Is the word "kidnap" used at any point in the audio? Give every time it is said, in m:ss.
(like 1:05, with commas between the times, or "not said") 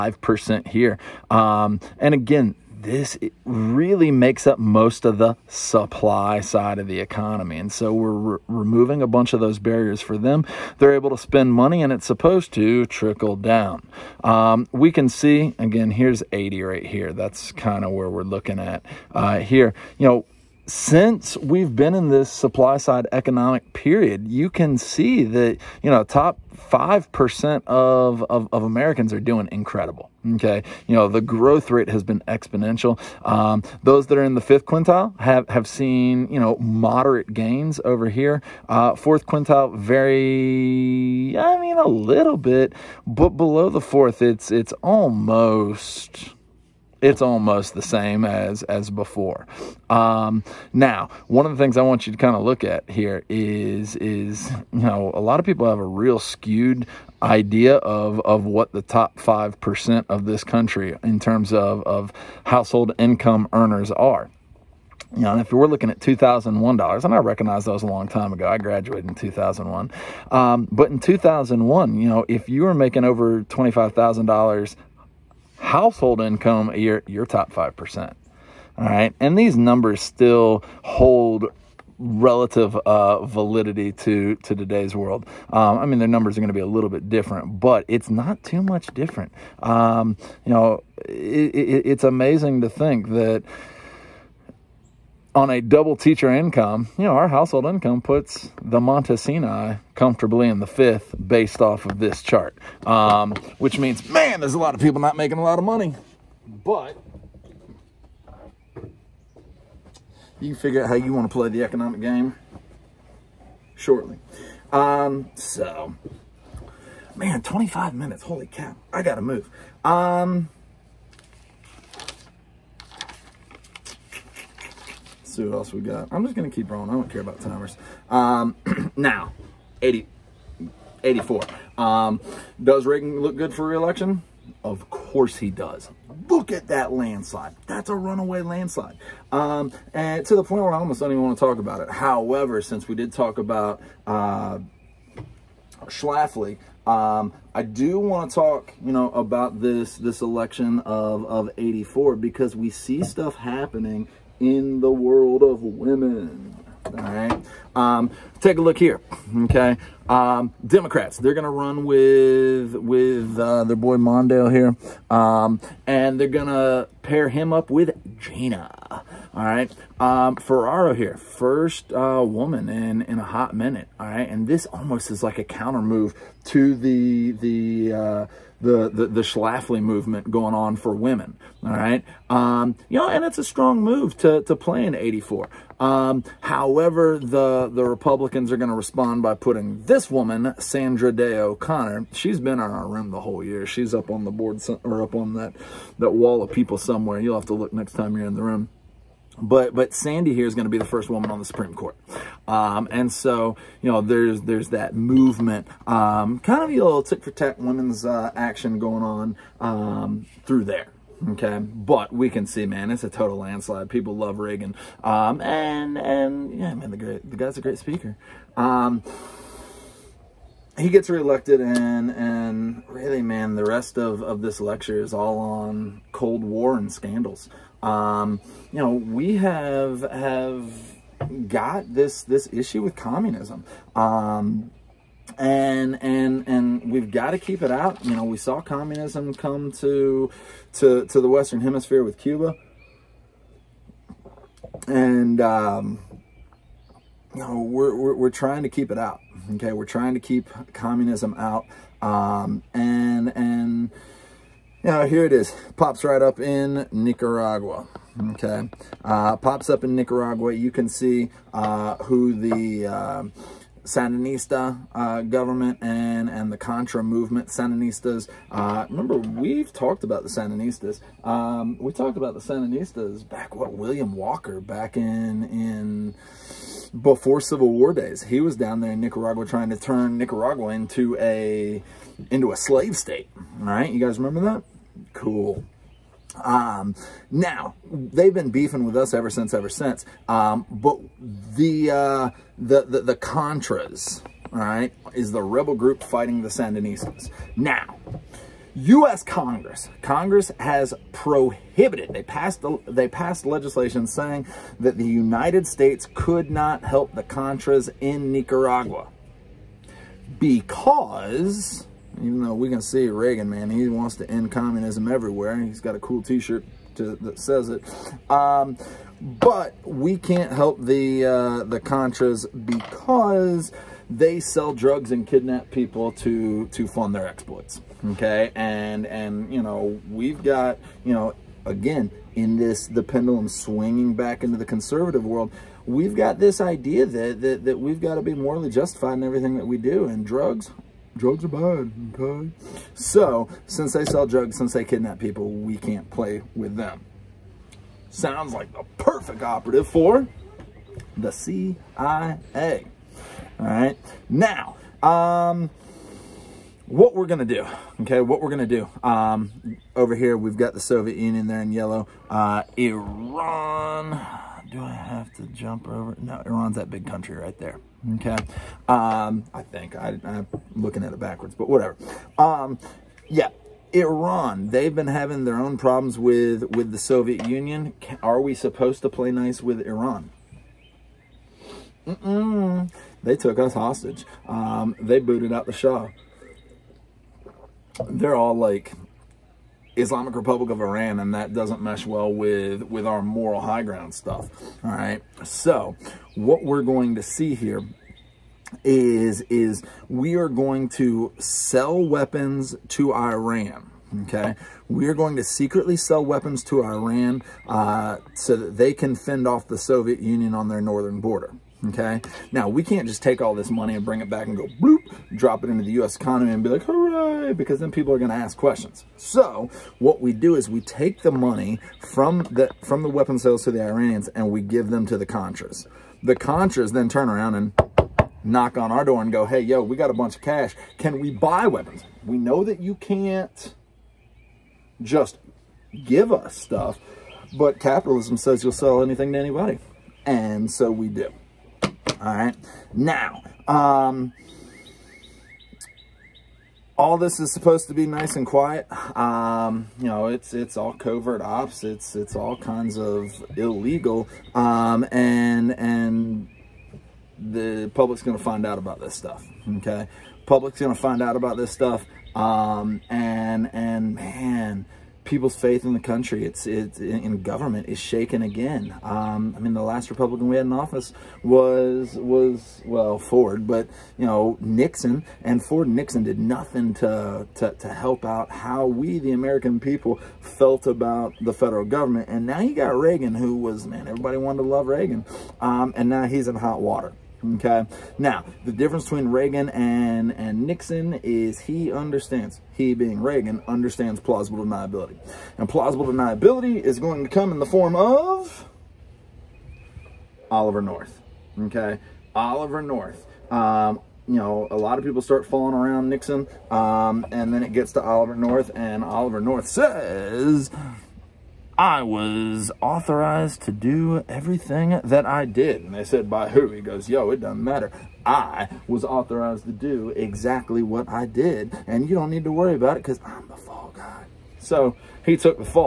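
5:25, 5:44.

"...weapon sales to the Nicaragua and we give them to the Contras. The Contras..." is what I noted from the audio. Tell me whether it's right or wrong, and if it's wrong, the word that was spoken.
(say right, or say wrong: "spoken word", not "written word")
wrong: "Iranians", not "Nicaragua".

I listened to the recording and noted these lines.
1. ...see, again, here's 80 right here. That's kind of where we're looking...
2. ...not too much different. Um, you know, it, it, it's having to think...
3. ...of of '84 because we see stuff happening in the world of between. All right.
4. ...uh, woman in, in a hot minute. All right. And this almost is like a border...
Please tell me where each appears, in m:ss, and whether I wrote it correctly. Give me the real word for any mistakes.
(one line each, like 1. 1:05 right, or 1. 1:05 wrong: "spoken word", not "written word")
1. 0:15 right
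2. 1:28 wrong: "amazing", not "having"
3. 2:30 wrong: "women", not "between"
4. 2:51 wrong: "counter", not "border".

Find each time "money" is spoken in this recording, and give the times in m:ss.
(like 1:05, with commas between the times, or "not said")
0:11, 1:45, 6:53, 7:01.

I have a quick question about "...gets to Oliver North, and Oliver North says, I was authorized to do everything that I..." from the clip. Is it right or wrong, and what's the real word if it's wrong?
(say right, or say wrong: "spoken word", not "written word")
right.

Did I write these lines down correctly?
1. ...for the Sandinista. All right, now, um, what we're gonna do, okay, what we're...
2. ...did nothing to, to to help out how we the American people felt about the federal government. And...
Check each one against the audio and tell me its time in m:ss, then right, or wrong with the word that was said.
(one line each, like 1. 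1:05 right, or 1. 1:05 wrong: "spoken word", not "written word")
1. 5:49 wrong: "CIA", not "Sandinista"
2. 7:56 right.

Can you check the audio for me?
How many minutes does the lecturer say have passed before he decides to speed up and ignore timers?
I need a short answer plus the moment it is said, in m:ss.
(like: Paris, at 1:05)
25, at 1:57.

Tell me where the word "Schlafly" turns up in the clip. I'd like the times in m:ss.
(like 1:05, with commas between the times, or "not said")
2:25, 2:59.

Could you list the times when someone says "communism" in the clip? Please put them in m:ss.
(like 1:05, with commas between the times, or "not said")
3:52, 3:58, 4:10, 5:14.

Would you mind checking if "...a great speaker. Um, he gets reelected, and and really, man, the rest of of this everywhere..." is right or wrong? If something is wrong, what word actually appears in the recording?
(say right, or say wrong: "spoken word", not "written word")
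wrong: "lecture", not "everywhere".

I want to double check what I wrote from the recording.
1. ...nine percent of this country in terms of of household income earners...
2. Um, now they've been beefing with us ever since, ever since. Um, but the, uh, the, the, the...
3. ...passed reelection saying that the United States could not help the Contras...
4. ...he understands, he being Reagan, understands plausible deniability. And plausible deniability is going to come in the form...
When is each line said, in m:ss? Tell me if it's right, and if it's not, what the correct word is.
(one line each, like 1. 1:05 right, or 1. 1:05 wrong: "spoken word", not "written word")
1. 0:59 wrong: "five", not "nine"
2. 4:46 right
3. 5:03 wrong: "legislation", not "reelection"
4. 8:11 right.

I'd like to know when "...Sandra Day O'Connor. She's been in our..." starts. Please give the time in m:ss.
3:10.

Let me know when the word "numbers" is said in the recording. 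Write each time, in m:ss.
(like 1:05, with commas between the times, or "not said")
1:19, 1:26.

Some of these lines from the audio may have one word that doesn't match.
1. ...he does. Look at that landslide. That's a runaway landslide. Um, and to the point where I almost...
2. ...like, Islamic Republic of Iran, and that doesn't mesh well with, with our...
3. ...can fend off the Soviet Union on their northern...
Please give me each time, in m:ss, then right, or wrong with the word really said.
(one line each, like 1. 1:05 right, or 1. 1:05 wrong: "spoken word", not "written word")
1. 2:15 right
2. 6:28 right
3. 6:48 right.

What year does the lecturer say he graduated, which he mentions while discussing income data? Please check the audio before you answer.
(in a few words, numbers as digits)
2001.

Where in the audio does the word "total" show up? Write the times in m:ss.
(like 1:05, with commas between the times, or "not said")
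3:33.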